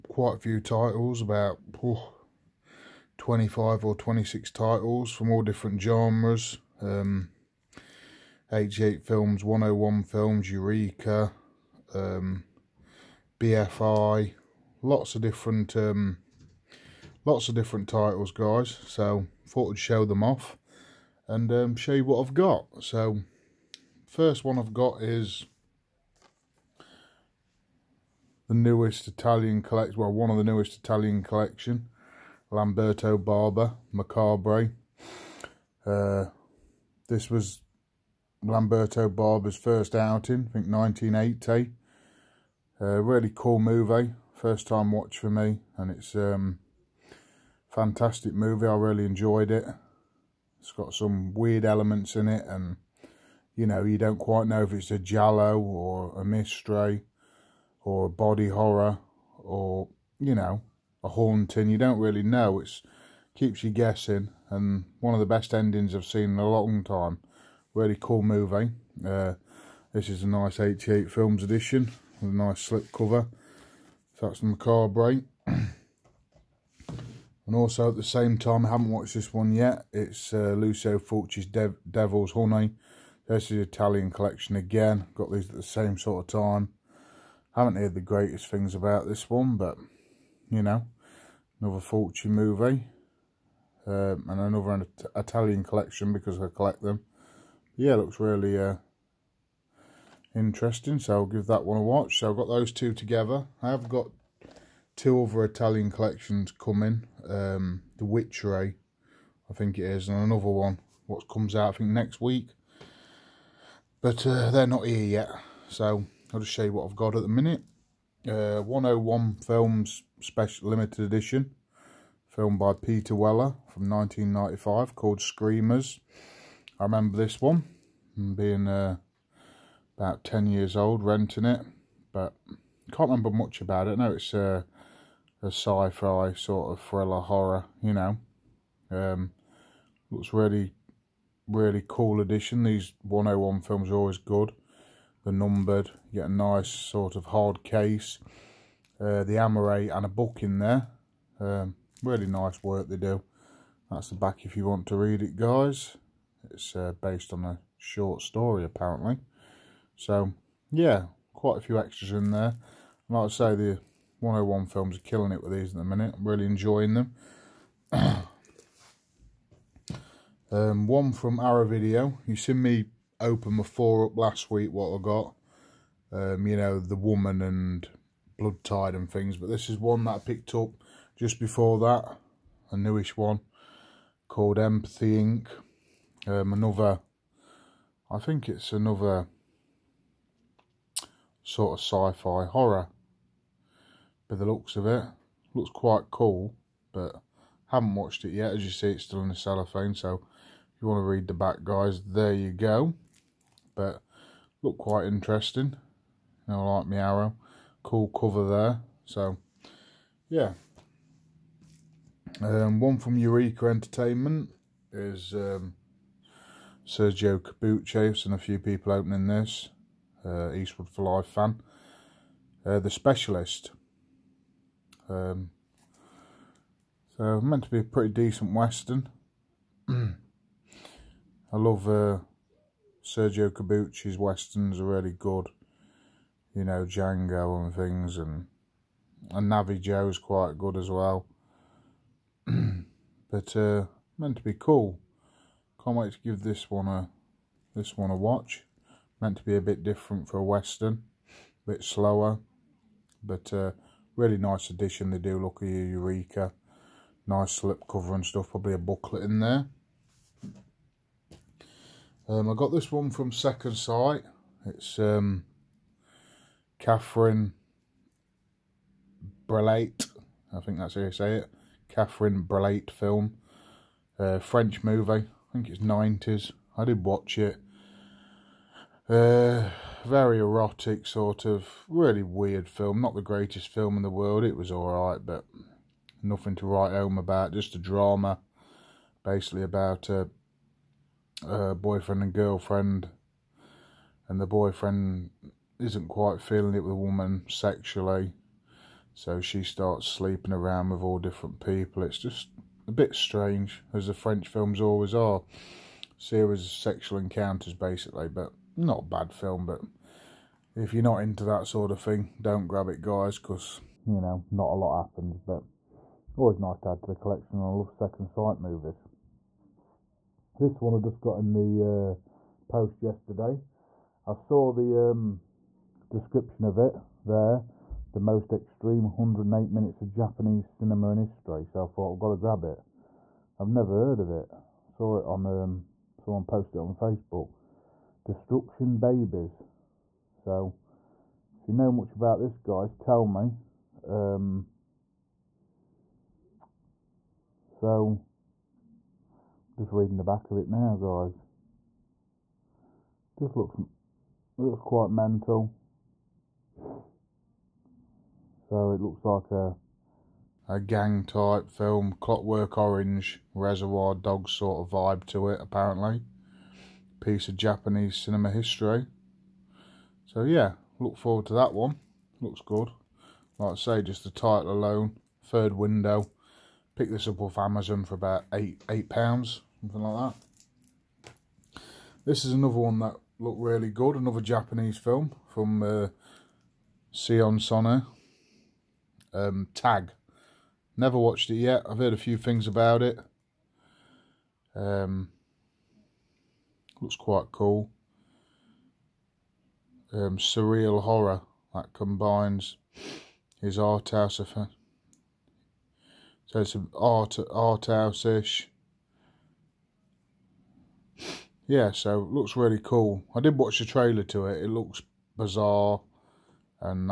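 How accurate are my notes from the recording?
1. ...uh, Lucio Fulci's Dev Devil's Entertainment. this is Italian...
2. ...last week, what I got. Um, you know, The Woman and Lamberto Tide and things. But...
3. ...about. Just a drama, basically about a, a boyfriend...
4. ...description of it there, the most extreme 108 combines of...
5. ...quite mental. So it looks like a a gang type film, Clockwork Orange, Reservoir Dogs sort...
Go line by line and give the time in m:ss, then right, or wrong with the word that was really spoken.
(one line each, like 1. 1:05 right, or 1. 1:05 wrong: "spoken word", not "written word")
1. 1:20 wrong: "Honey", not "Entertainment"
2. 2:54 wrong: "Blood", not "Lamberto"
3. 4:47 right
4. 5:26 wrong: "minutes", not "combines"
5. 5:54 right.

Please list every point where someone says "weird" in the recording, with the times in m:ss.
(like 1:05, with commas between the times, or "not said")
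0:51, 4:42.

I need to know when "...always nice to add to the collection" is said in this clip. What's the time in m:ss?
5:16.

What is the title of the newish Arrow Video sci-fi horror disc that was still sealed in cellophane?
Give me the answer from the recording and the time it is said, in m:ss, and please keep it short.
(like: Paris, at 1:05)
Empathy Inc., at 3:04.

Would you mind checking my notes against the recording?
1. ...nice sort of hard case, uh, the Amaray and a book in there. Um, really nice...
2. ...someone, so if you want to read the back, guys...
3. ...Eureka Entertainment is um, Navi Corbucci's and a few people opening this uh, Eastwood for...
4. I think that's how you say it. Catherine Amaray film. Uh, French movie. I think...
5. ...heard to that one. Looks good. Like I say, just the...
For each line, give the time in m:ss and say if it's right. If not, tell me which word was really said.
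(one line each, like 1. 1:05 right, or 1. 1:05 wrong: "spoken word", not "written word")
1. 2:26 right
2. 3:19 wrong: "cellophane", not "someone"
3. 3:33 wrong: "Sergio", not "Navi"
4. 4:30 wrong: "Breillat", not "Amaray"
5. 6:11 wrong: "forward", not "heard".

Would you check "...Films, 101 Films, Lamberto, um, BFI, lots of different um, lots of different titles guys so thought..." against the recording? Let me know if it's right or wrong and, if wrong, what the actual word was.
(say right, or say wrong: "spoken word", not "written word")
wrong: "Eureka", not "Lamberto".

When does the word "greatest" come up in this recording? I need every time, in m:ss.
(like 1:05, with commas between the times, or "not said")
1:28, 4:43.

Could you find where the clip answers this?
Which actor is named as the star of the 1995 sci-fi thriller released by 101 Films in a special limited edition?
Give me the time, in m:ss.
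2:02.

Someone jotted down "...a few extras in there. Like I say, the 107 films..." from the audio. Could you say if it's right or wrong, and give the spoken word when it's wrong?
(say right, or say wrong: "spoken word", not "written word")
wrong: "101", not "107".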